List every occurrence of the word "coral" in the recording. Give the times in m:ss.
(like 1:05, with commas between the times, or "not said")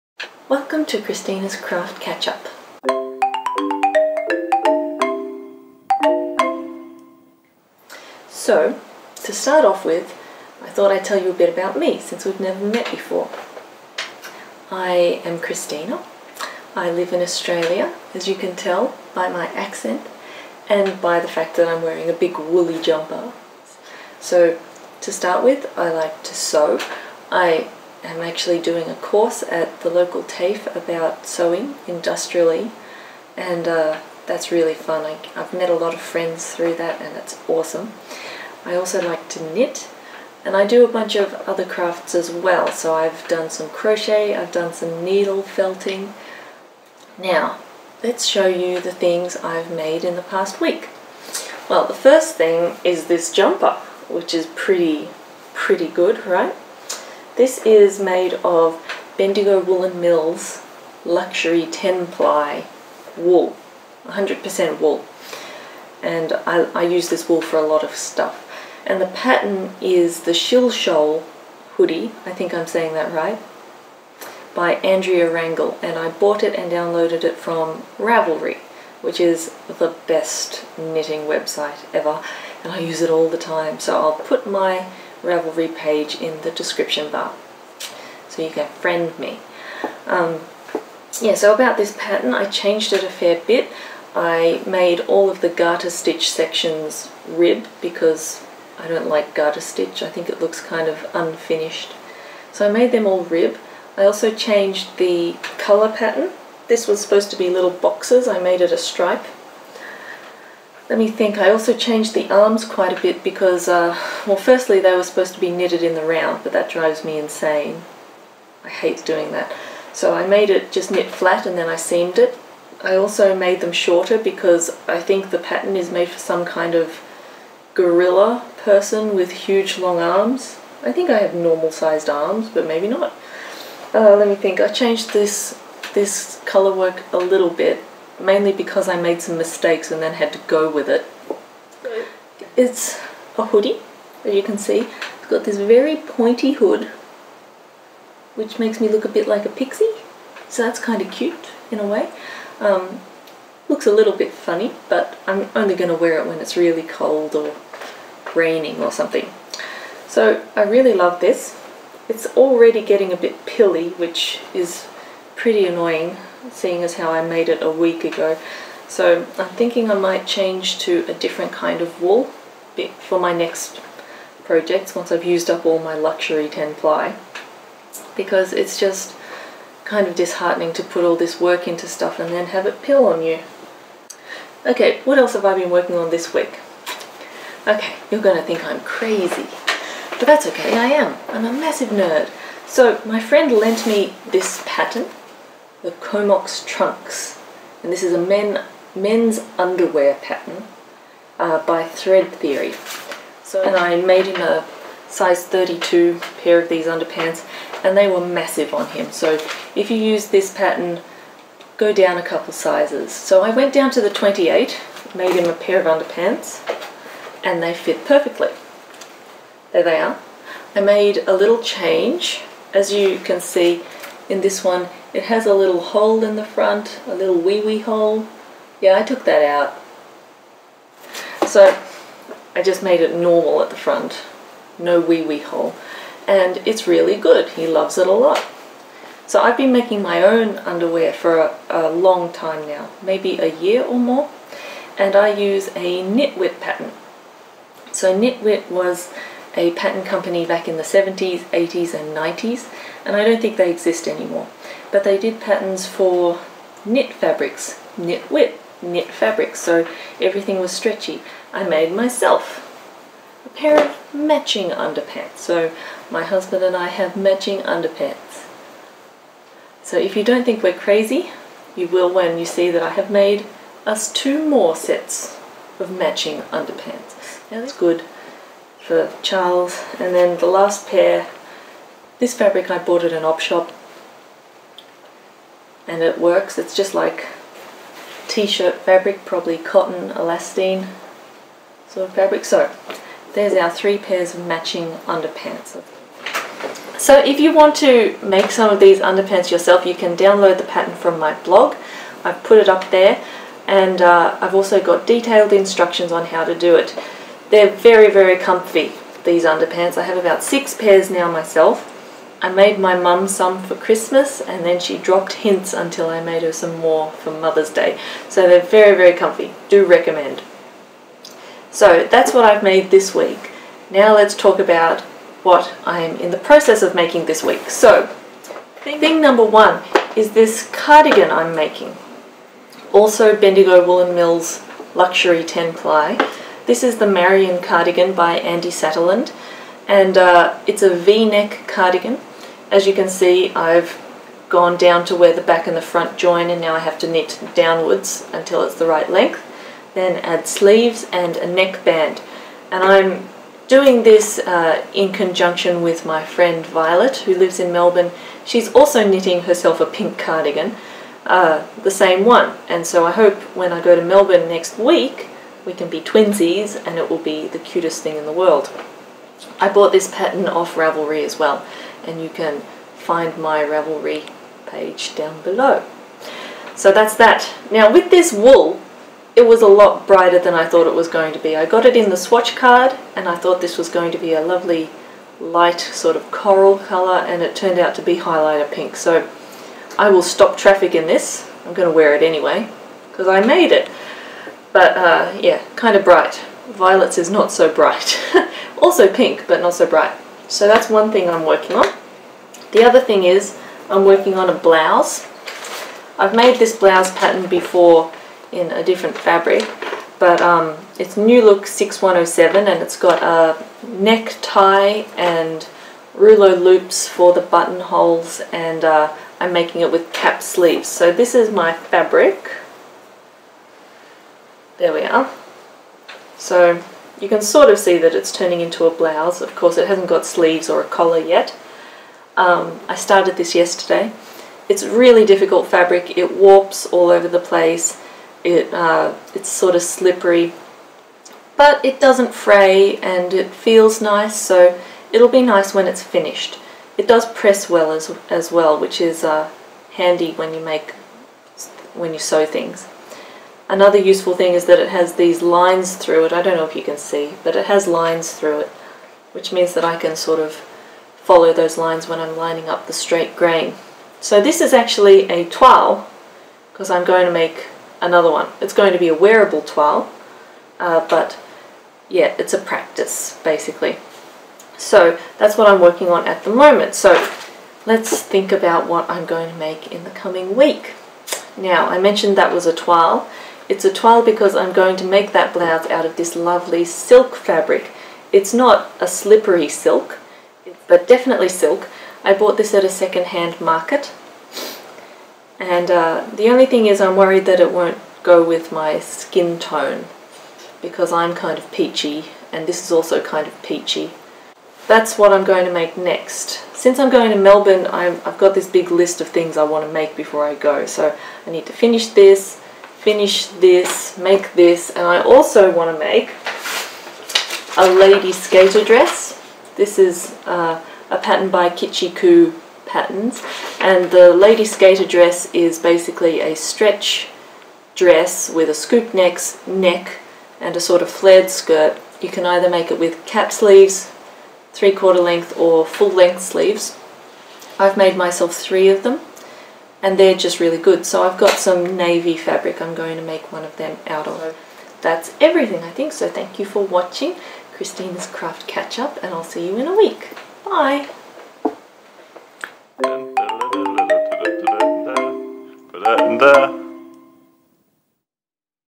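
6:26.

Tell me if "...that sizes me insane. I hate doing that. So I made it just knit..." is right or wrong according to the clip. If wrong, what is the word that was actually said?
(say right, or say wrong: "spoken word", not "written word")
wrong: "drives", not "sizes".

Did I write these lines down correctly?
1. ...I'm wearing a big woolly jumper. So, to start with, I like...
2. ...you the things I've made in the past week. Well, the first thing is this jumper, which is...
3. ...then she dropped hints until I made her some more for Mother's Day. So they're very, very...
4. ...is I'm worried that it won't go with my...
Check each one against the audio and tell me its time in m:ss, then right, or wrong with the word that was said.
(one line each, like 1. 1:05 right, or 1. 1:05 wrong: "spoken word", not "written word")
1. 0:21 right
2. 0:48 right
3. 5:14 right
4. 8:16 right.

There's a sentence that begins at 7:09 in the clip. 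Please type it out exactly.
Of course, it hasn't got sleeves or a collar yet.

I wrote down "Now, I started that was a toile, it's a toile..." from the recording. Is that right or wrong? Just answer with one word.
wrong.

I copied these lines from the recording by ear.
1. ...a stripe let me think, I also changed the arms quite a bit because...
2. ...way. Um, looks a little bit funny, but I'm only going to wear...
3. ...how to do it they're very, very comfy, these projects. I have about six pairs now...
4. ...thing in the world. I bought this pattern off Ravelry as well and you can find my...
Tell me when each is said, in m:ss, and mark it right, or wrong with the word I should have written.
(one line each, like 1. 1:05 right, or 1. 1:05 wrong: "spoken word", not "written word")
1. 1:48 right
2. 2:31 right
3. 5:06 wrong: "underpants", not "projects"
4. 6:08 right.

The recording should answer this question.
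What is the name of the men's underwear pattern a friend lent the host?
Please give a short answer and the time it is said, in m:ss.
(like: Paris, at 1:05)
Comox Trunks, at 3:15.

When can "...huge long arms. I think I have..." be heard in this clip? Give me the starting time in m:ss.
2:09.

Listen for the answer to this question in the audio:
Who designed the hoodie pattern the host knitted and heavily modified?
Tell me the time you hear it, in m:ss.
1:14.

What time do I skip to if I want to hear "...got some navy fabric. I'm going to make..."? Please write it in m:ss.
9:01.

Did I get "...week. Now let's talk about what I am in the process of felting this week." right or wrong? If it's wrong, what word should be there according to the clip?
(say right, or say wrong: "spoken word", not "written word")
wrong: "making", not "felting".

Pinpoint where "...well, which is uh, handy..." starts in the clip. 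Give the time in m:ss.
7:28.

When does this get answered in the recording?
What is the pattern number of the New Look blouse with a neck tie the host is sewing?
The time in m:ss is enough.
6:51.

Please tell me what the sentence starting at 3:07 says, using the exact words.
Okay, you're going to think I'm crazy, but that's okay, I am.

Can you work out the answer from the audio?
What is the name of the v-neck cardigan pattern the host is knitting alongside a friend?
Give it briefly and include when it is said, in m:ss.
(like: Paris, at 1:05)
Marion cardigan, at 5:37.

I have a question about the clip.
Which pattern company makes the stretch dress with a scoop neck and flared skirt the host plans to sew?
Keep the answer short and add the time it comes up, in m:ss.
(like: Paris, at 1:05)
Kitschy Coo Patterns, at 8:41.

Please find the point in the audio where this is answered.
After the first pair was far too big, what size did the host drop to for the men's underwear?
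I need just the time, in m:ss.
3:34.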